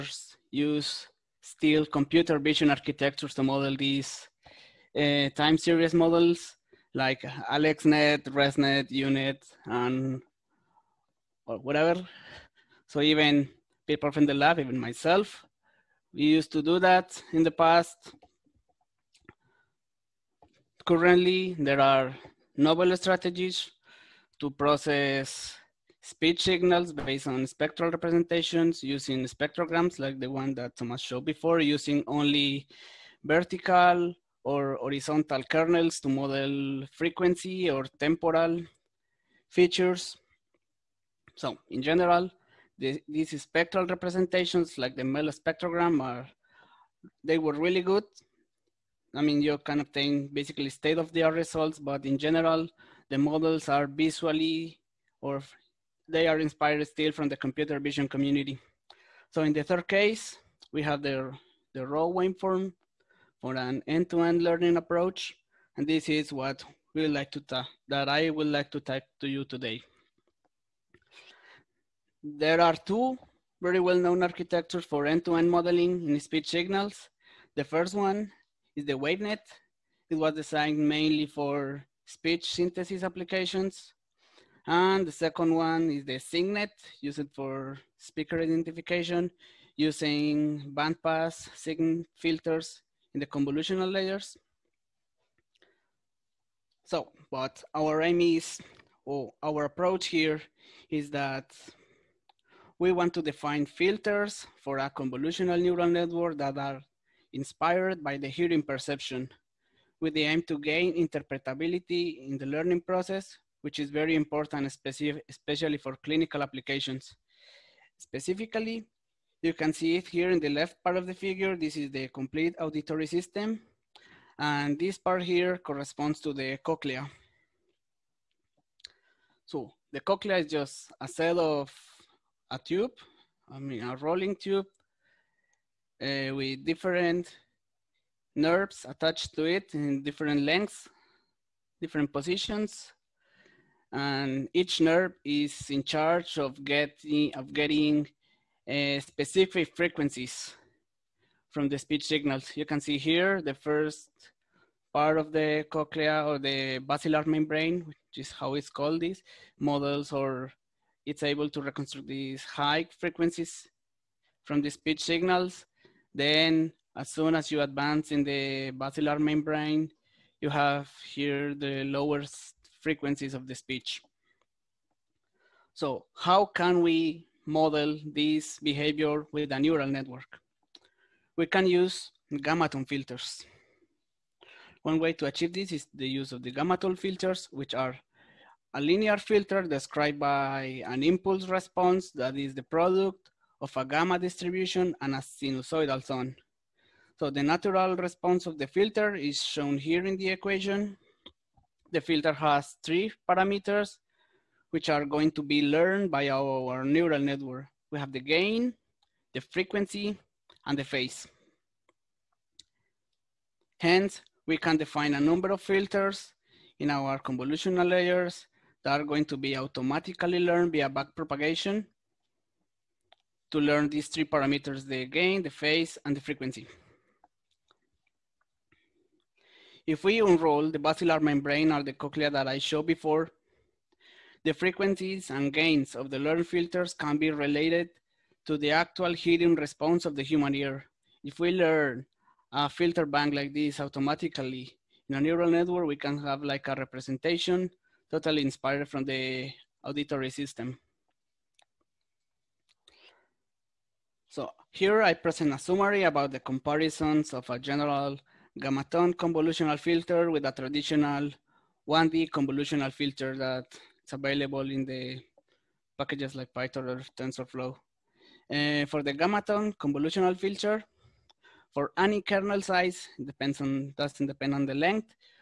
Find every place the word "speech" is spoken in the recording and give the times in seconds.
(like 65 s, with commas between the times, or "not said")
26 s, 76 s, 82 s, 151 s, 164 s, 173 s.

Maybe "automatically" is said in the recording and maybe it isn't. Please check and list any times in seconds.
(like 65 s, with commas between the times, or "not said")
219 s, 243 s.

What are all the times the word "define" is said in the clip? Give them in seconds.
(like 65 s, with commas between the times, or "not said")
103 s, 214 s.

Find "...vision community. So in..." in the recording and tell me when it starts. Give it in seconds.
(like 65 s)
57 s.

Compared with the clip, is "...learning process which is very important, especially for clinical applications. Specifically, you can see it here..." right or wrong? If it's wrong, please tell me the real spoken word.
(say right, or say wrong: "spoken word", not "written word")
right.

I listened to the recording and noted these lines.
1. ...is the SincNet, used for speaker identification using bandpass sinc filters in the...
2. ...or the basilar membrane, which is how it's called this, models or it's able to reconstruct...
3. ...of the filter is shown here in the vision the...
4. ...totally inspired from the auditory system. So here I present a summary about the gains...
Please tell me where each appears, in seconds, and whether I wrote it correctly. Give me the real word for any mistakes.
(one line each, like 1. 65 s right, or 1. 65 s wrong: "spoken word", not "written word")
1. 85 s right
2. 156 s right
3. 198 s wrong: "equation", not "vision"
4. 248 s wrong: "comparisons", not "gains".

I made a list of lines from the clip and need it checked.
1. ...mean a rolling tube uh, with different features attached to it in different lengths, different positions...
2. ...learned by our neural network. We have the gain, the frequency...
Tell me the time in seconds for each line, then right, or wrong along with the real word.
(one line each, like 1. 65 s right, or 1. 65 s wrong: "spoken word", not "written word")
1. 133 s wrong: "nerves", not "features"
2. 205 s right.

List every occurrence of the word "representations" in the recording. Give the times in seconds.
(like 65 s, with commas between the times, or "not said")
27 s, 43 s, 246 s.